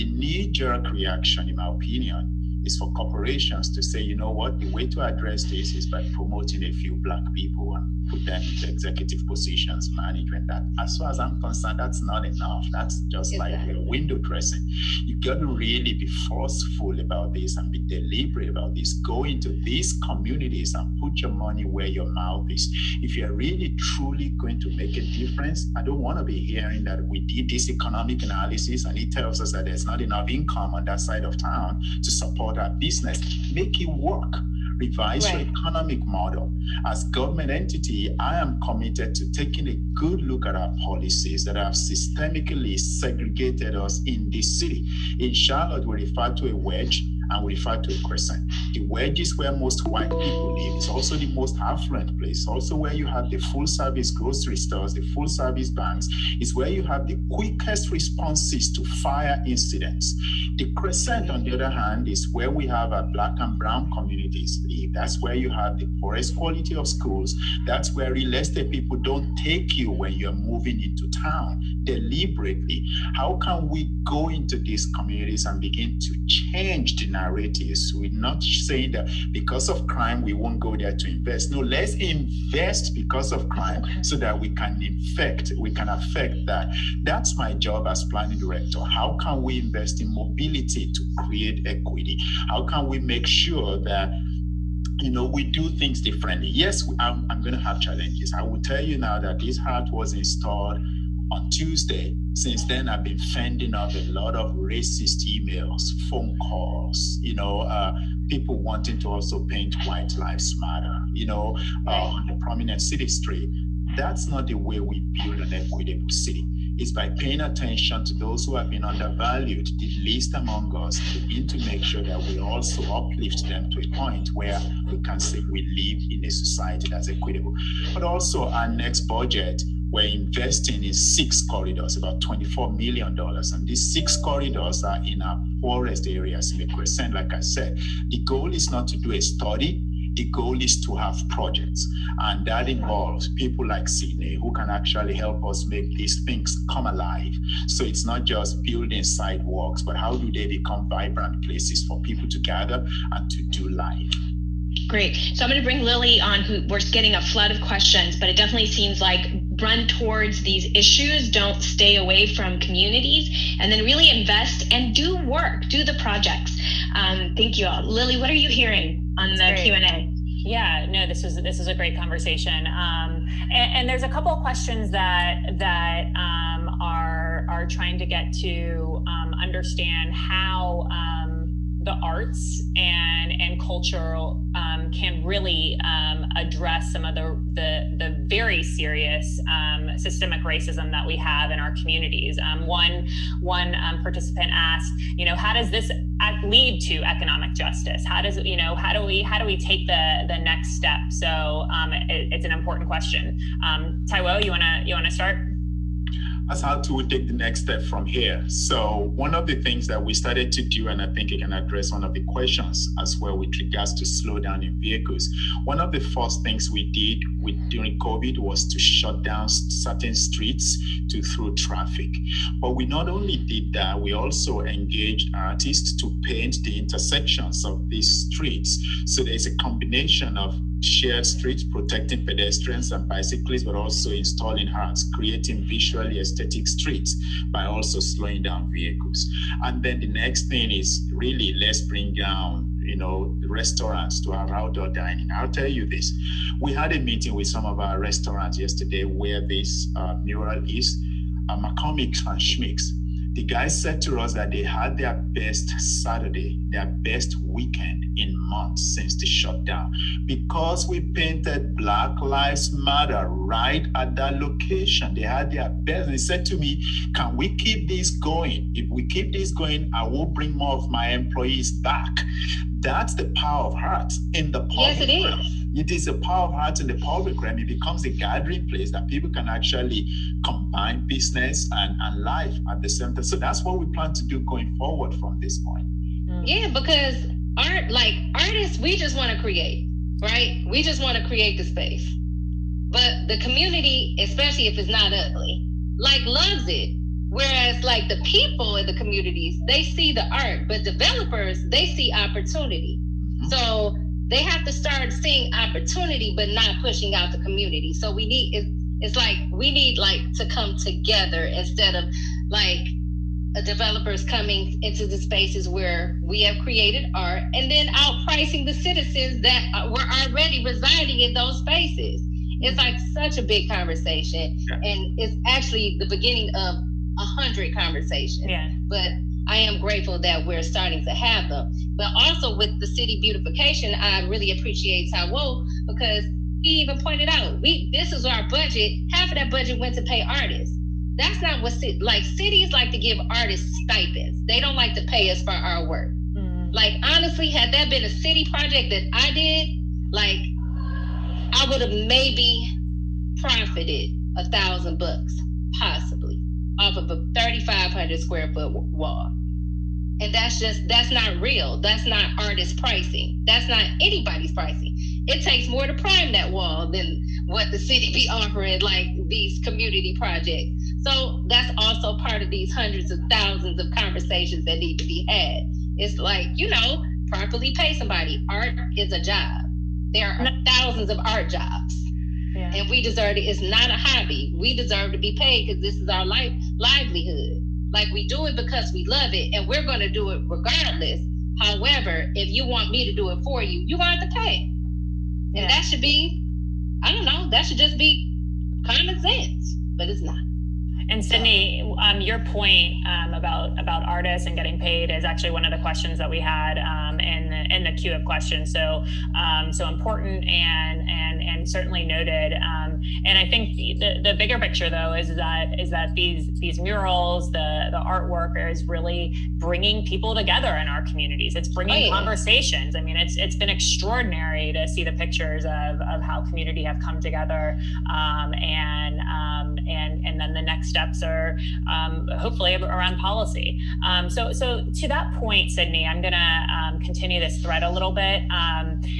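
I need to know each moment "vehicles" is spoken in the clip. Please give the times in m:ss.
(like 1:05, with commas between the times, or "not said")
3:34, 3:58.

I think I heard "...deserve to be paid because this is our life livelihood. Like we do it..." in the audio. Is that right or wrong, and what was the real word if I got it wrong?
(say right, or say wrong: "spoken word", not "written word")
right.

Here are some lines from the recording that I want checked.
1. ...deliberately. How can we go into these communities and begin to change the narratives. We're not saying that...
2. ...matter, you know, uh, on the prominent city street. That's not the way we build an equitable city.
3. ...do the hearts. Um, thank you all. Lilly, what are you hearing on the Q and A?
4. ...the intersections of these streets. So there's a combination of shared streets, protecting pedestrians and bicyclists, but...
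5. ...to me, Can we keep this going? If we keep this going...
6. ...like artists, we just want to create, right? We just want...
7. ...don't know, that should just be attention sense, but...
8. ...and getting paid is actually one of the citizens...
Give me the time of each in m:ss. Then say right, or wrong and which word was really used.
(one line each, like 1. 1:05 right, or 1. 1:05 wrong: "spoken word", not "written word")
1. 1:11 right
2. 1:50 right
3. 2:45 wrong: "projects", not "hearts"
4. 3:46 right
5. 4:26 right
6. 4:47 right
7. 6:37 wrong: "common", not "attention"
8. 6:44 wrong: "questions", not "citizens".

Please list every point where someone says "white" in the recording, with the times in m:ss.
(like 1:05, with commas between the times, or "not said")
0:49, 1:49.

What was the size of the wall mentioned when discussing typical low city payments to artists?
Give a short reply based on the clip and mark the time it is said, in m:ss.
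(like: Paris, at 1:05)
3,500 square feet, at 5:57.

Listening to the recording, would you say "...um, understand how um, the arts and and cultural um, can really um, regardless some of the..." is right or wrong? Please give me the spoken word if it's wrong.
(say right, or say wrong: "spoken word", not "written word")
wrong: "address", not "regardless".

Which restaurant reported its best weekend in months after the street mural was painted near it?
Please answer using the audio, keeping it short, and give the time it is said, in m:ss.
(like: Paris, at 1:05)
McCormick and Schmick's, at 4:11.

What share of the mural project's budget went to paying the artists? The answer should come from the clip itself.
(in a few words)
Half.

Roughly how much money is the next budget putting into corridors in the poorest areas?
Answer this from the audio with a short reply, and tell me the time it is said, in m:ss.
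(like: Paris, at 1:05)
$24 million, at 2:12.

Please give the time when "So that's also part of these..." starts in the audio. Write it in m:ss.
6:11.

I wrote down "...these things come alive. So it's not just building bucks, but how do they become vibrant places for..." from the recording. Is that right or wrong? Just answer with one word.
wrong.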